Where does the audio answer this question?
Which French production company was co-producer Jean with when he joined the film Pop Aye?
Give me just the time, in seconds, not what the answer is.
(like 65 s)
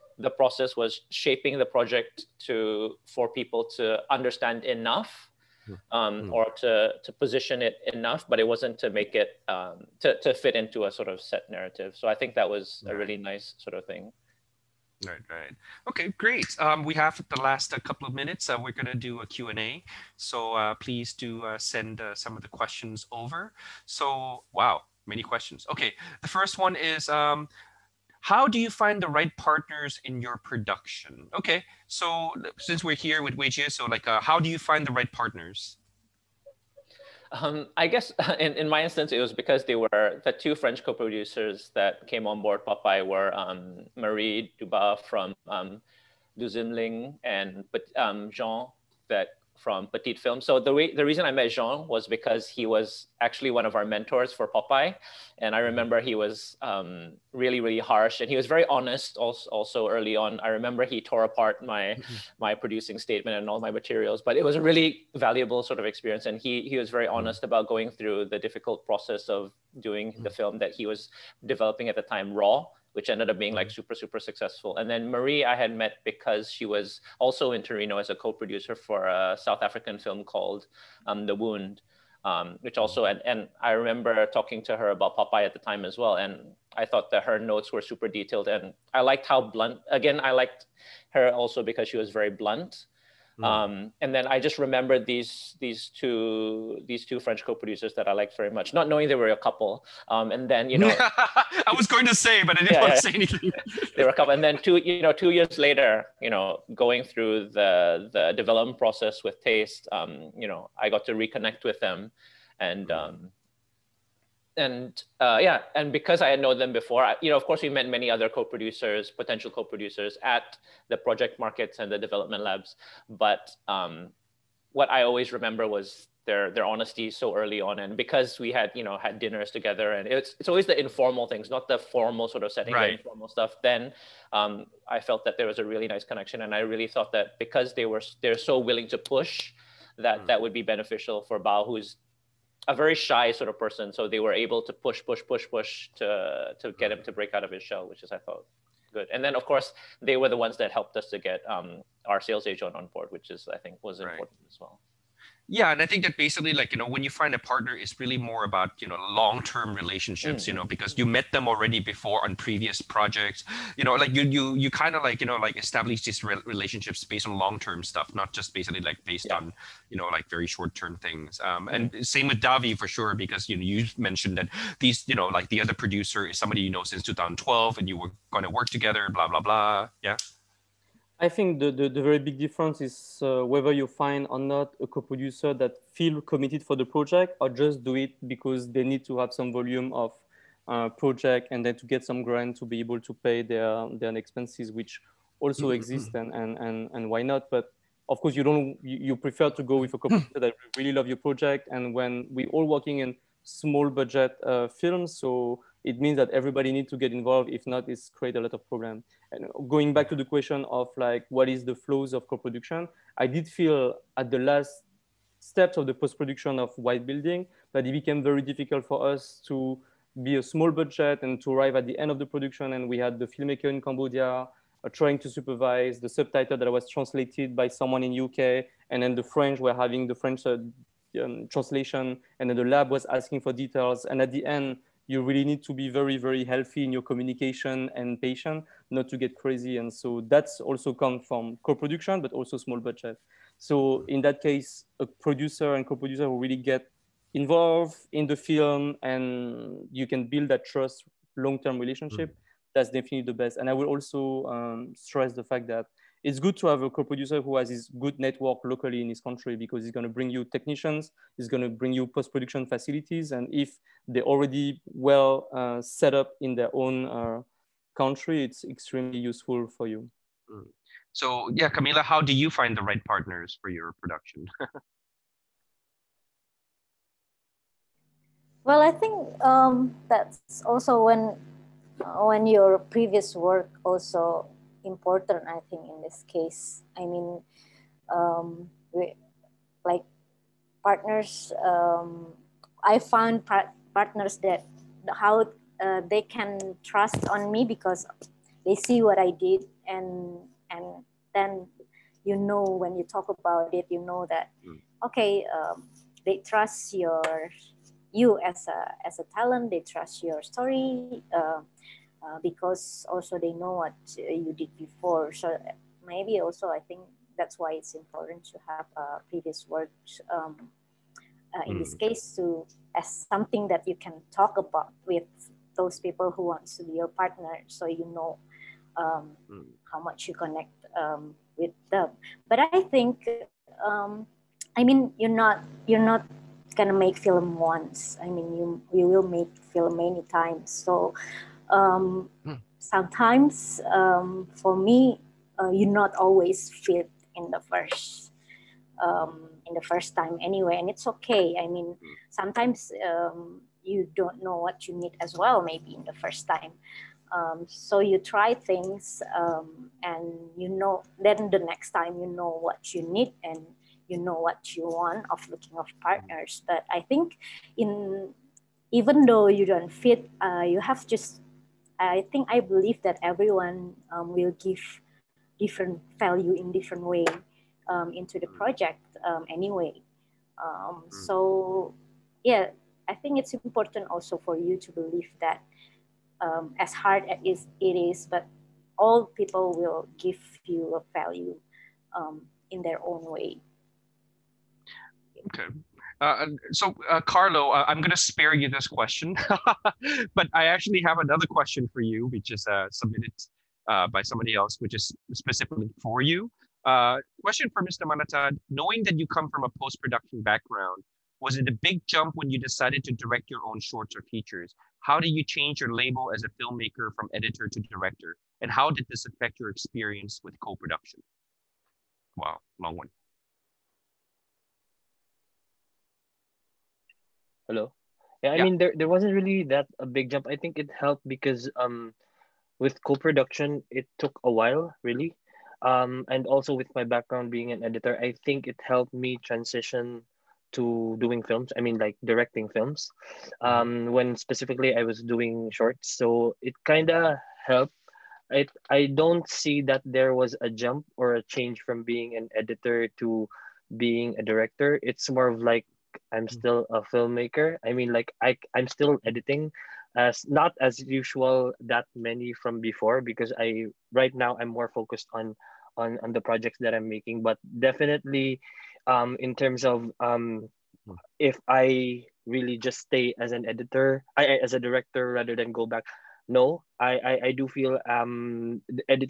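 49 s.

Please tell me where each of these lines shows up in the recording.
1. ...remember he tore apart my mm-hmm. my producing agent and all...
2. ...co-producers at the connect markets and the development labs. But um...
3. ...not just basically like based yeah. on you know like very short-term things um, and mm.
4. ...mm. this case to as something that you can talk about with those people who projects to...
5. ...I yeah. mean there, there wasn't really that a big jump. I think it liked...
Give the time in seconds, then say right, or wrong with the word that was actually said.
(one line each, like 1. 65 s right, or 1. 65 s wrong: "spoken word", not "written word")
1. 60 s wrong: "statement", not "agent"
2. 119 s wrong: "project", not "connect"
3. 168 s right
4. 321 s wrong: "wants", not "projects"
5. 428 s wrong: "helped", not "liked".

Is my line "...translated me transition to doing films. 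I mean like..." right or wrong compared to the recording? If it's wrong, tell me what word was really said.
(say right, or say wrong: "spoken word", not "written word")
wrong: "helped", not "translated".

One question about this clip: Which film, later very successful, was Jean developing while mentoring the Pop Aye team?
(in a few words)
Raw.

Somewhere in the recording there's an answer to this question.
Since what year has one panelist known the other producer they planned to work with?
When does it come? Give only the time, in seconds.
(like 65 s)
177 s.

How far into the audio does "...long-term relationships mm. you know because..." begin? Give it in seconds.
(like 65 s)
159 s.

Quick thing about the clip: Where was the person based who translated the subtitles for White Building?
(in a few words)
UK.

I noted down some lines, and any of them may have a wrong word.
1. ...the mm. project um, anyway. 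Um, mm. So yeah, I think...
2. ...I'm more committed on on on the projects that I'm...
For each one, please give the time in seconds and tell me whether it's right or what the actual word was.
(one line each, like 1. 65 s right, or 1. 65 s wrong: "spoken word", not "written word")
1. 378 s right
2. 464 s wrong: "focused", not "committed".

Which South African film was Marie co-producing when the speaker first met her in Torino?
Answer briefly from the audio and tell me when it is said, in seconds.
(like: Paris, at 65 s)
The Wound, at 81 s.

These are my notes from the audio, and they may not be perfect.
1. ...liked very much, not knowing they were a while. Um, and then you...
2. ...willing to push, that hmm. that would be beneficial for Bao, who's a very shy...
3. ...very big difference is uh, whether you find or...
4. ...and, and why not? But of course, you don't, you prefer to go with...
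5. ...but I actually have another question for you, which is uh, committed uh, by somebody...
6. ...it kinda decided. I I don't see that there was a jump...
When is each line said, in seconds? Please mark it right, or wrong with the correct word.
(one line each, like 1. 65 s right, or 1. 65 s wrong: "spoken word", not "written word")
1. 98 s wrong: "couple", not "while"
2. 138 s right
3. 182 s right
4. 196 s right
5. 400 s wrong: "submitted", not "committed"
6. 446 s wrong: "helped", not "decided".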